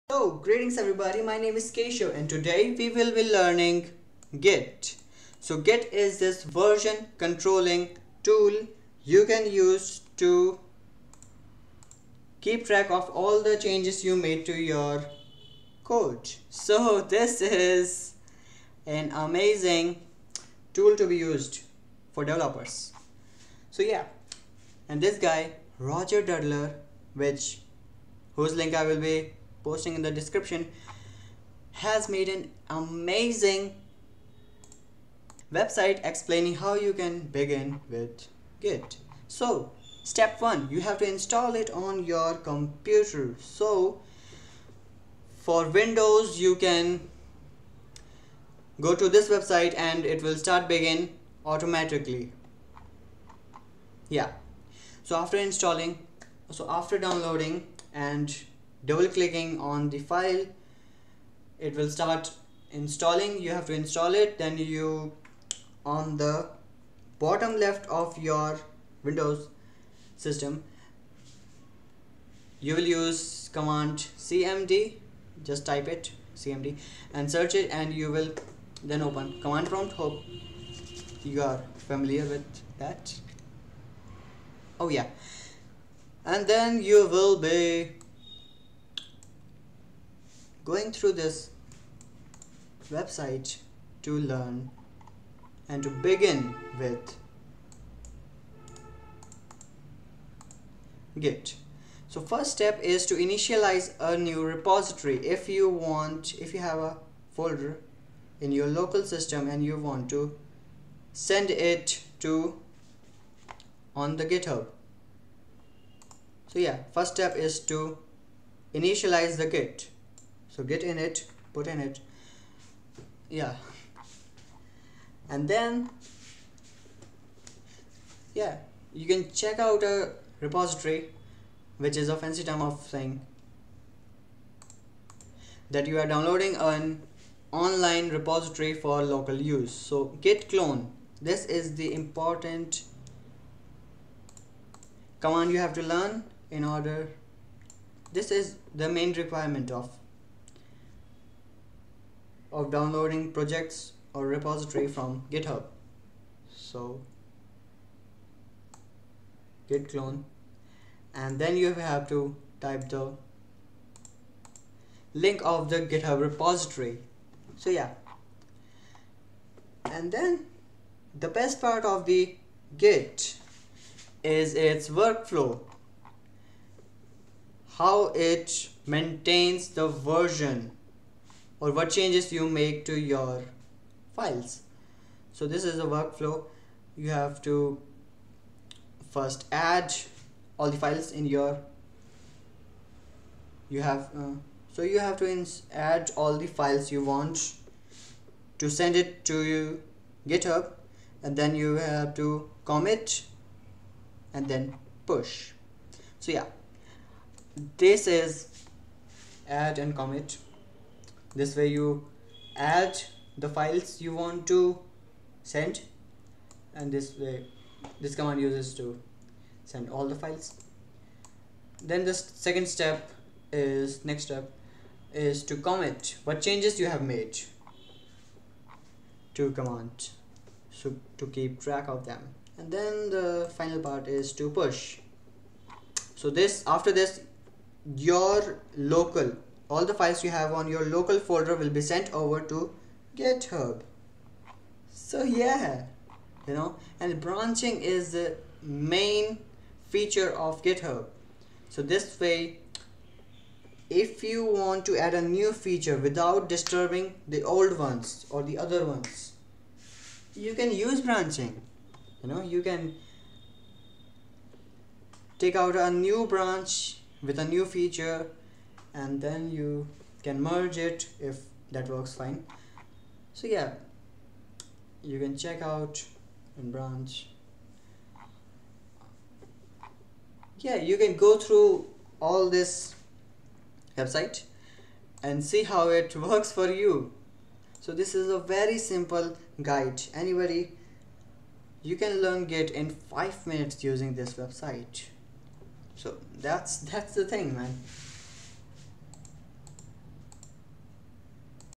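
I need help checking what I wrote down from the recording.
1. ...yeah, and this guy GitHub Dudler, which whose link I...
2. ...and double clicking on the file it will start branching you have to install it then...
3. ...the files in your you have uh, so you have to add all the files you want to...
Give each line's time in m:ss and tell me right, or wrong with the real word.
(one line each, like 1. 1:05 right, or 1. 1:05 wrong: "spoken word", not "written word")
1. 0:23 wrong: "Roger", not "GitHub"
2. 0:57 wrong: "installing", not "branching"
3. 3:10 right.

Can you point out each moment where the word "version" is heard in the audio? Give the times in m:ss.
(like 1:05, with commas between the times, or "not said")
0:06, 2:59.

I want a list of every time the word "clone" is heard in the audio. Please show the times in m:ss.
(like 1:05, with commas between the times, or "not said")
2:20, 2:39.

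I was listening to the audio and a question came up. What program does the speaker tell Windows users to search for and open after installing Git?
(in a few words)
Command prompt.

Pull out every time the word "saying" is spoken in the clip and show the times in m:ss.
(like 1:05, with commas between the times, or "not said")
2:12.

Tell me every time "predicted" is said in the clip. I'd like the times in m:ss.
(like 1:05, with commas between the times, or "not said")
not said.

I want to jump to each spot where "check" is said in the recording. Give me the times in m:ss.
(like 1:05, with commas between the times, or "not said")
2:09, 4:35.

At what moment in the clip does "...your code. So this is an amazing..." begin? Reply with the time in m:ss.
0:14.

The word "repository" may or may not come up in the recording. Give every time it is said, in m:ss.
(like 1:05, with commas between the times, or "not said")
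1:44, 2:10, 2:18, 2:34, 2:46.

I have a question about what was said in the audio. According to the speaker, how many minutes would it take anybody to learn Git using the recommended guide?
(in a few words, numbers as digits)
5.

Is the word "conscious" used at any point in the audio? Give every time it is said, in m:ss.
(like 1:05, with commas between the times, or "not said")
not said.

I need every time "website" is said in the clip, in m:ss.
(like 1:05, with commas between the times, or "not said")
0:35, 0:49, 1:32, 4:43, 4:54.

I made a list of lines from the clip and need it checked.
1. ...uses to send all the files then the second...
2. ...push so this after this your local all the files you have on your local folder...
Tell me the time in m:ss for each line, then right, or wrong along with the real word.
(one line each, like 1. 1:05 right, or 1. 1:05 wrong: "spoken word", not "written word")
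1. 3:38 right
2. 3:54 right.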